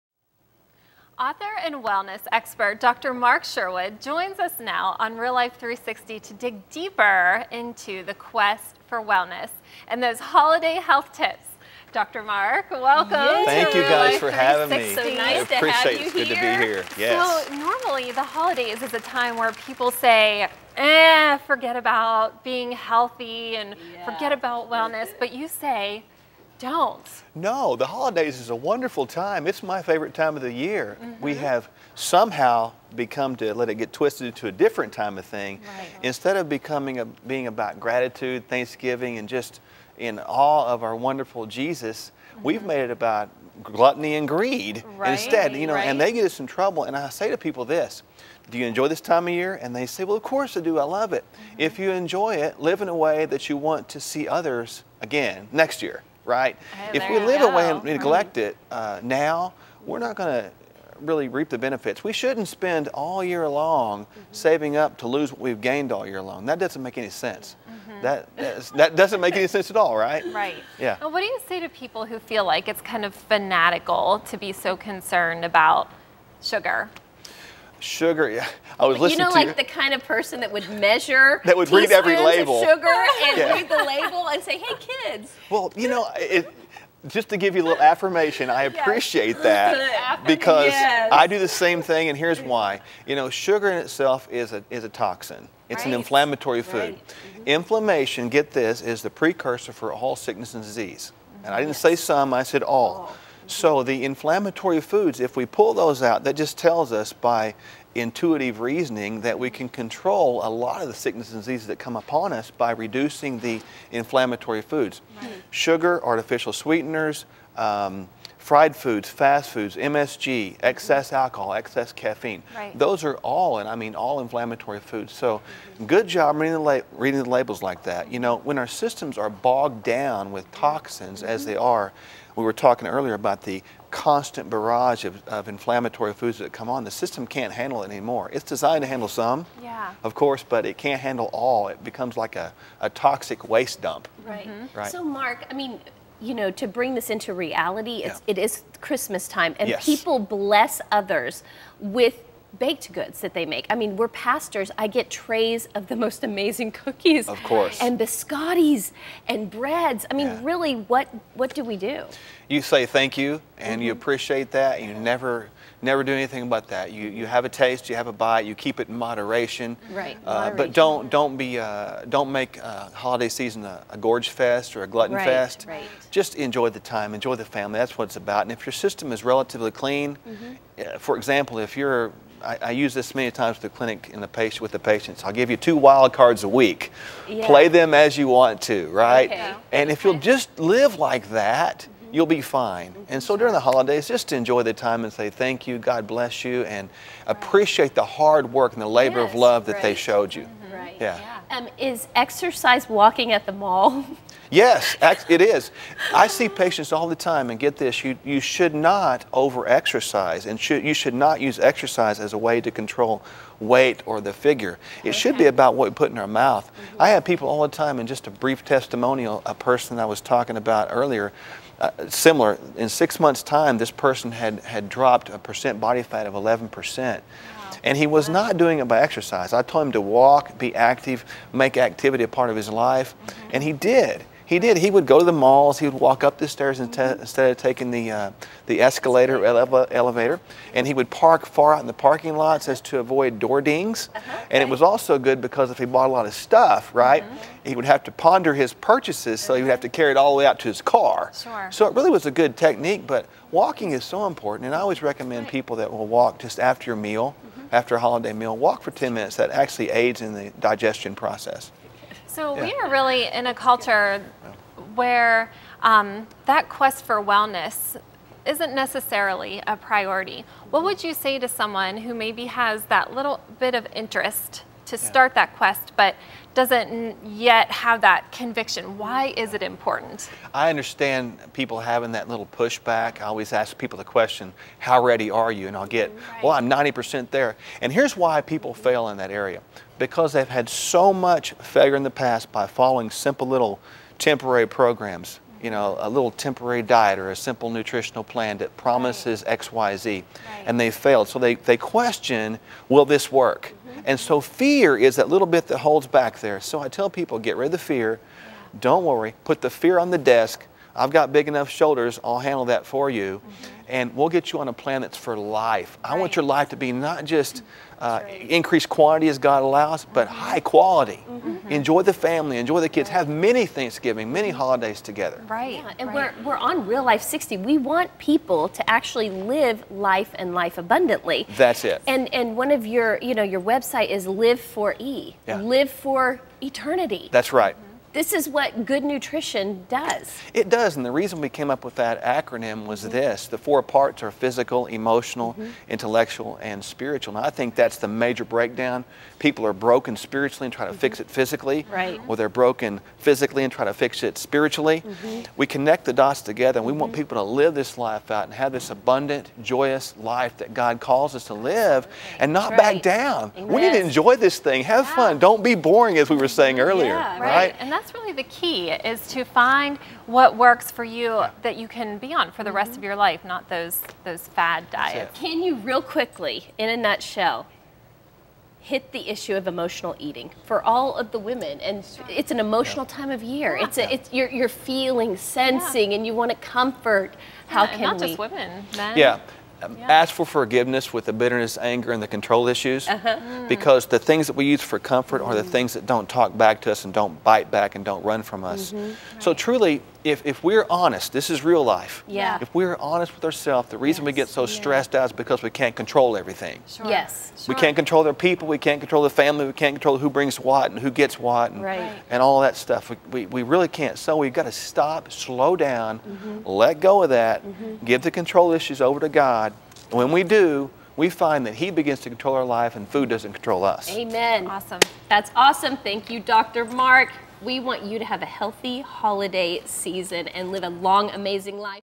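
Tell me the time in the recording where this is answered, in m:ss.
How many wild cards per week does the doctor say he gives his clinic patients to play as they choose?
3:05.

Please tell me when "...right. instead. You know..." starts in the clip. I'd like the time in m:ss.
0:44.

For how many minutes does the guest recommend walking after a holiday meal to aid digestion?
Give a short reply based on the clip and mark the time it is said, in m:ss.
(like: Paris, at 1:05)
10, at 4:18.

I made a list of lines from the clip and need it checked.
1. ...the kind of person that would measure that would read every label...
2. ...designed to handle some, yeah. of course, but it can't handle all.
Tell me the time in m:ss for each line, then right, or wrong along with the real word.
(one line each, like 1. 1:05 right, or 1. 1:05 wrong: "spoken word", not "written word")
1. 1:19 right
2. 2:18 right.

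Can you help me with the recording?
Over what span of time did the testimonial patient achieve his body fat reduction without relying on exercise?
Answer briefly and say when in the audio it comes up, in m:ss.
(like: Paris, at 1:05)
6 months, at 3:42.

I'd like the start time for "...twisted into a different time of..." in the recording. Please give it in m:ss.
0:33.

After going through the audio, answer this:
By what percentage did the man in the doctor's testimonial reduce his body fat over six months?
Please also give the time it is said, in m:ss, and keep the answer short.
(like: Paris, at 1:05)
11%, at 3:46.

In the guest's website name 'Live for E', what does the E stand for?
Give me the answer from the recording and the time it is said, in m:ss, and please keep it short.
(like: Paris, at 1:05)
Eternity, at 5:36.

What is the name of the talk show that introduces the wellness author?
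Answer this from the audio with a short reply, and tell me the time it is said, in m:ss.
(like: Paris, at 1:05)
Real Life 360, at 0:05.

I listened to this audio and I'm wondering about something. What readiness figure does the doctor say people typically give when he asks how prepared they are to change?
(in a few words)
90%.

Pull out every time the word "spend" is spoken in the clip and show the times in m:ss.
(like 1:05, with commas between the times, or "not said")
1:02.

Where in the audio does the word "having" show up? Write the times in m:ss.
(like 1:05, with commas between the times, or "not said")
0:14, 4:41.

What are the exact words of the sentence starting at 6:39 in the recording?
So, truly, if, if we're honest, this is real life.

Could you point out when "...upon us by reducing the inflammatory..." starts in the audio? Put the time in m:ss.
1:51.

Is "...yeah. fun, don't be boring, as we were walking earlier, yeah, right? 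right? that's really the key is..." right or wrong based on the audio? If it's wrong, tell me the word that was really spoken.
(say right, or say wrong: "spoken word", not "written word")
wrong: "saying", not "walking".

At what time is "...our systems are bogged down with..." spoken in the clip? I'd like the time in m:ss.
2:08.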